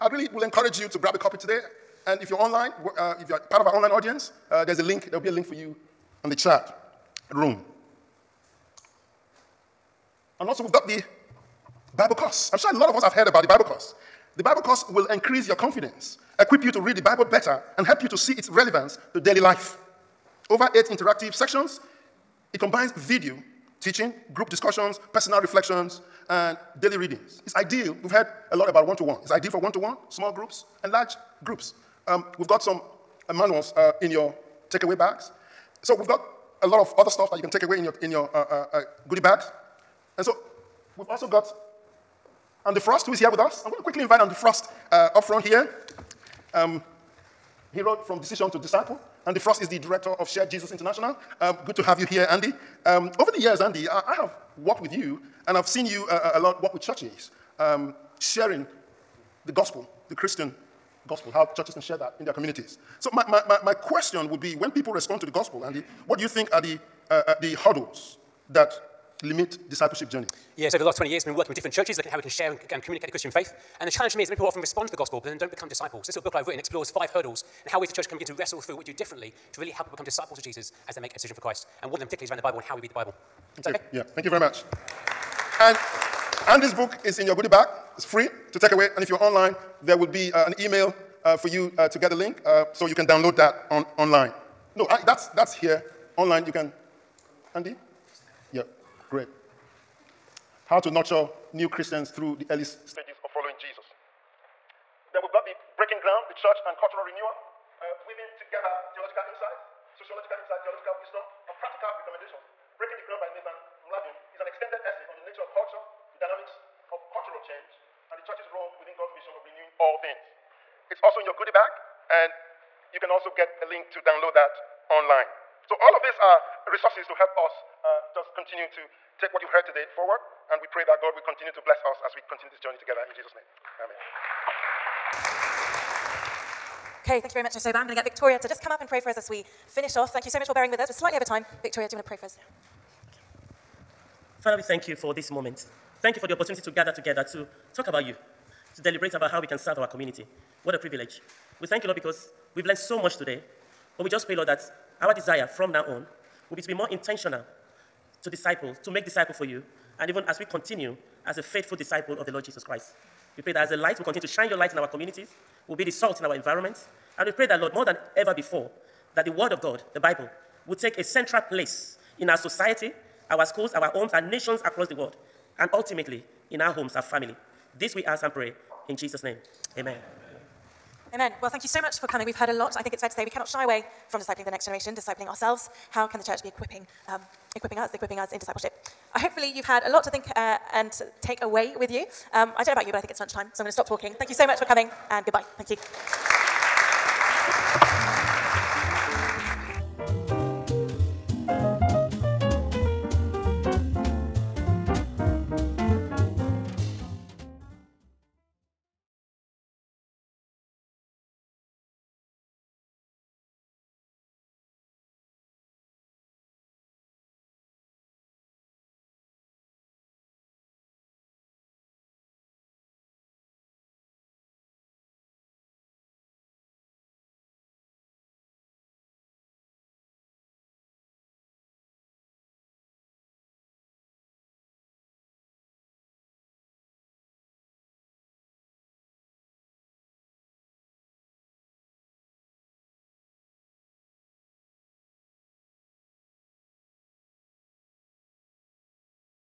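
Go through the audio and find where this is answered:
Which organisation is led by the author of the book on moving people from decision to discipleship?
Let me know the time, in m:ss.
0:50.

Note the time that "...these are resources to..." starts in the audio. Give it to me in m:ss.
2:06.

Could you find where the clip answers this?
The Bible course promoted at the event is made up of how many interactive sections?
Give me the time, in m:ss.
0:20.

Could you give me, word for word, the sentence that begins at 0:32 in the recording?
Um, we've got some uh, manuals uh, in your takeaway bags.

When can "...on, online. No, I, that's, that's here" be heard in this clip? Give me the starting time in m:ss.
1:33.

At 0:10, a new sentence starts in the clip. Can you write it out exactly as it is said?
And also, we've got the Bible course.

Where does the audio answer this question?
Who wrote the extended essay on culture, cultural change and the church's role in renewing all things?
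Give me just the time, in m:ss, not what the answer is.
1:53.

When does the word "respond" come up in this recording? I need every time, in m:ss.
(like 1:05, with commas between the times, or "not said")
1:04, 1:14.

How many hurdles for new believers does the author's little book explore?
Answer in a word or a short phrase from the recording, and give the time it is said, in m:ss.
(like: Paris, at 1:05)
5, at 1:16.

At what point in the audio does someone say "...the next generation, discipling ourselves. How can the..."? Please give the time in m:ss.
3:04.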